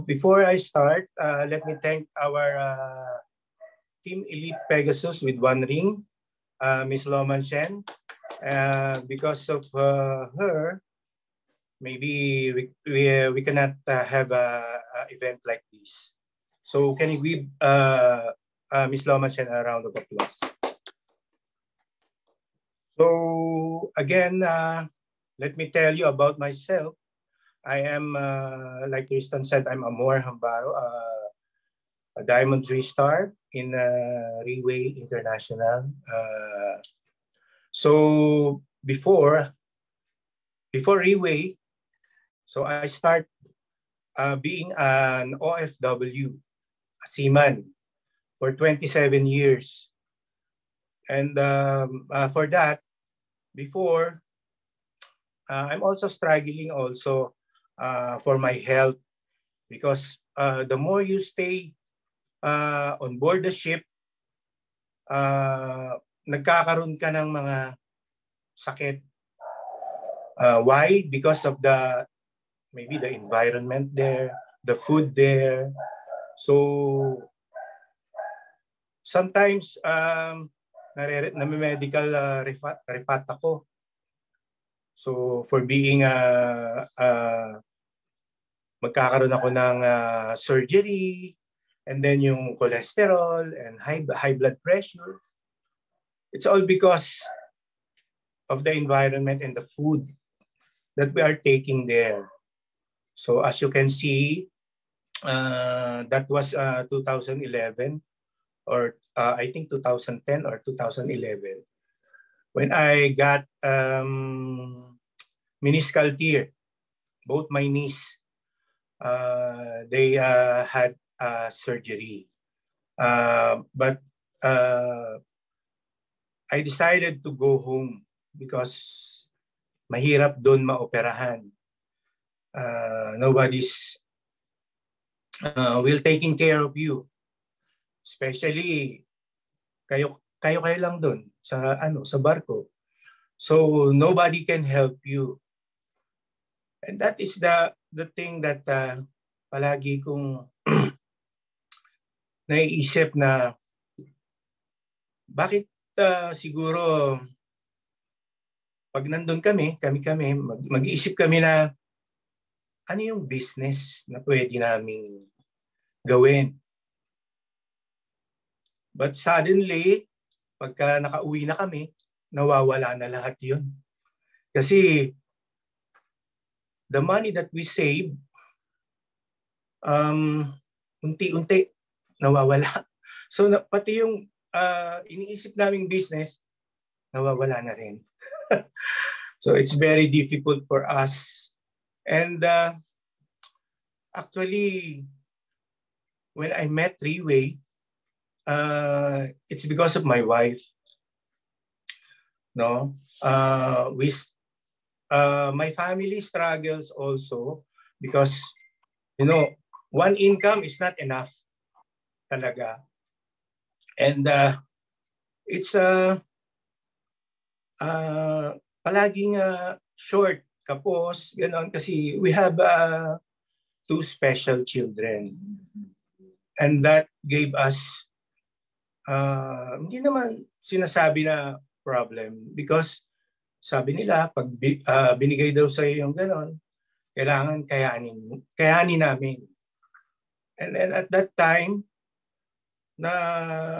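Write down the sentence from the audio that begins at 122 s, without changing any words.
Uh, but uh, I decided to go home because mahirap doon maoperahan.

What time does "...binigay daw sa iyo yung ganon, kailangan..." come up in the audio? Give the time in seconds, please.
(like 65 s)
235 s.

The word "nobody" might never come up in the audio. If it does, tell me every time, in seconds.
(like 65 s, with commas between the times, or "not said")
133 s, 143 s.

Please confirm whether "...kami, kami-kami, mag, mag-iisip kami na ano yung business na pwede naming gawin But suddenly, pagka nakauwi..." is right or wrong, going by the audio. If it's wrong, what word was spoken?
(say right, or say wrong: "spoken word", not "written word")
right.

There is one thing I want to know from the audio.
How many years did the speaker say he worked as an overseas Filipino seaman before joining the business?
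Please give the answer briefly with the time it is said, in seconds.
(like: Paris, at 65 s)
27, at 48 s.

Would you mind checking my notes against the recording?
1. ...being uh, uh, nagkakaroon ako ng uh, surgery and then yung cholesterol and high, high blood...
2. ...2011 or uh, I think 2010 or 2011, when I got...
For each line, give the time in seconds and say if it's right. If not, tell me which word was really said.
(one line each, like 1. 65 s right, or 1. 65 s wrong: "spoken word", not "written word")
1. 85 s wrong: "magkakaroon", not "nagkakaroon"
2. 106 s right.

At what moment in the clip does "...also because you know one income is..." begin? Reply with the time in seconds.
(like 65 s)
206 s.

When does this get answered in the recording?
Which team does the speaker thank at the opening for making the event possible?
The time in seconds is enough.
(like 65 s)
4 s.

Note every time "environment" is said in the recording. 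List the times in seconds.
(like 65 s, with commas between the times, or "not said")
73 s, 98 s.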